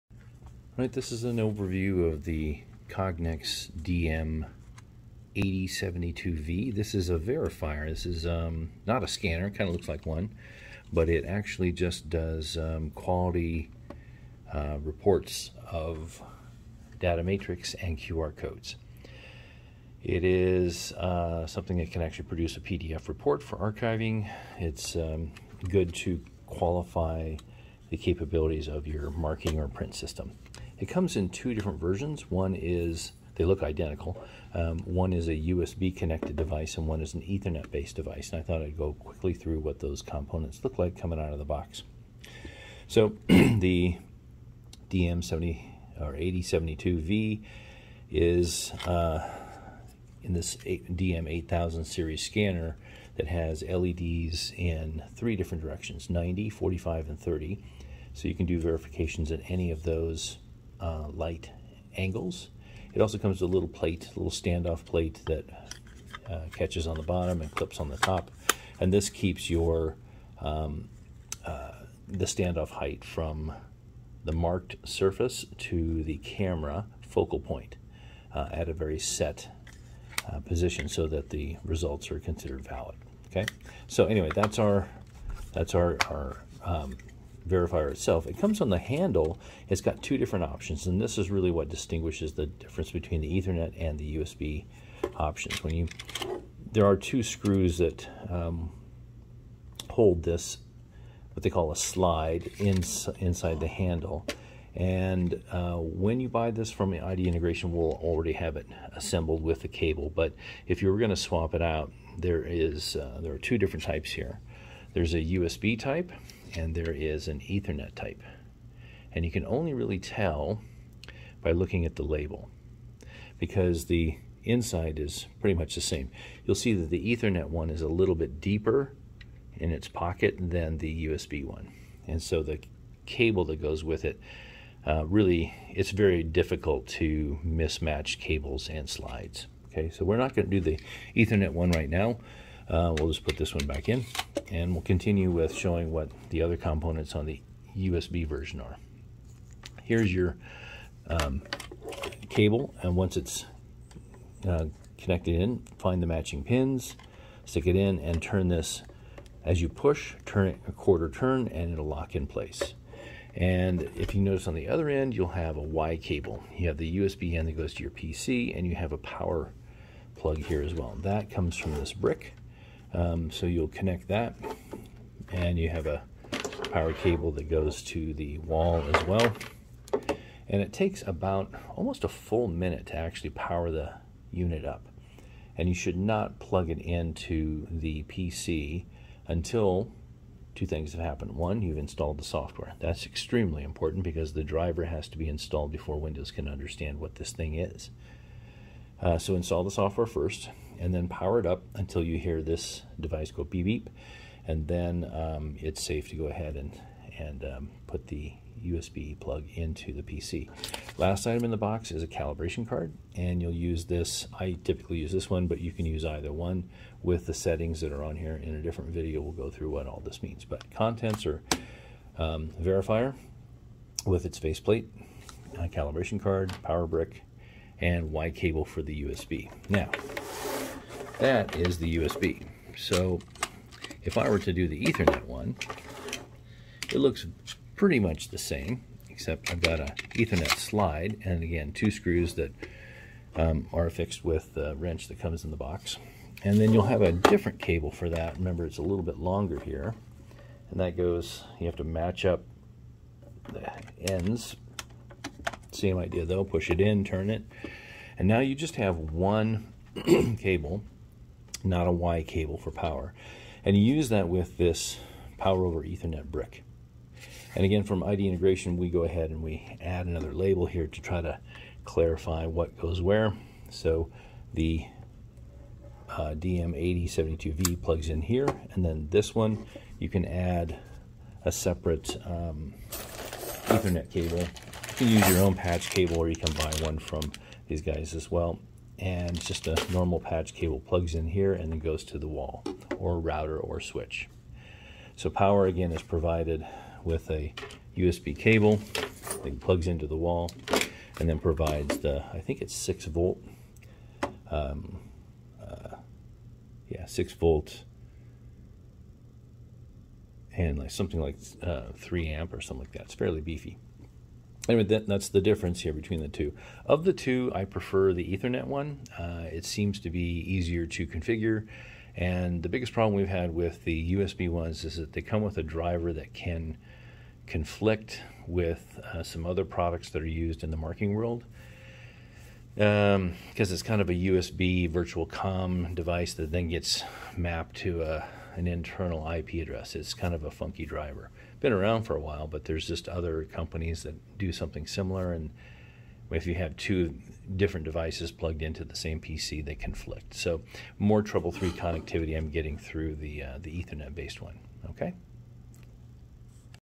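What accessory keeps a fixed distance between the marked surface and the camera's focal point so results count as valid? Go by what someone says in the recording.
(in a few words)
standoff plate.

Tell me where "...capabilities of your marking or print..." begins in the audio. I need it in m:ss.
0:27.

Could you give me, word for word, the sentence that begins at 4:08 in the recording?
Remember, it's a little bit longer here.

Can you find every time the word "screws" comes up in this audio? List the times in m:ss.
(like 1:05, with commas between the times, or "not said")
1:37, 4:01.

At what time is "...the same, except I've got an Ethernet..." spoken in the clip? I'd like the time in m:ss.
3:58.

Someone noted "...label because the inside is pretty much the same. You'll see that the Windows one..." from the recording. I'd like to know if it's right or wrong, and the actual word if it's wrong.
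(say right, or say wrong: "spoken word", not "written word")
wrong: "Ethernet", not "Windows".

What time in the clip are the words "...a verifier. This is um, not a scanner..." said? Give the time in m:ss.
0:07.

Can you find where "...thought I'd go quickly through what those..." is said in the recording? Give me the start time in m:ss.
0:38.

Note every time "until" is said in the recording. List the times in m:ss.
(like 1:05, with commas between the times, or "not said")
3:09, 3:21.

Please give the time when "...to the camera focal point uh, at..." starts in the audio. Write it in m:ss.
1:15.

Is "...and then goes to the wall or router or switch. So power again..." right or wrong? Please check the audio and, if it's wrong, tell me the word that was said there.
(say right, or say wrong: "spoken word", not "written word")
right.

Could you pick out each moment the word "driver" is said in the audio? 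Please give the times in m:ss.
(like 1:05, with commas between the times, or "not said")
3:14, 5:25, 5:40.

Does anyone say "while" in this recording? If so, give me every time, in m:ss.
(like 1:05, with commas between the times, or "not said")
5:42.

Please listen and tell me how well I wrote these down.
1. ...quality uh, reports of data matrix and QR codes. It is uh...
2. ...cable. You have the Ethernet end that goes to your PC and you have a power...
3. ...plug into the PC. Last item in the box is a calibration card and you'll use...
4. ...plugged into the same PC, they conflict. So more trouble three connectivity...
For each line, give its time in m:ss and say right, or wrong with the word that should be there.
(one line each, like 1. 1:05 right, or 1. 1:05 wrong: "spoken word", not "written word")
1. 0:12 right
2. 2:45 wrong: "USB", not "Ethernet"
3. 3:29 right
4. 5:48 right.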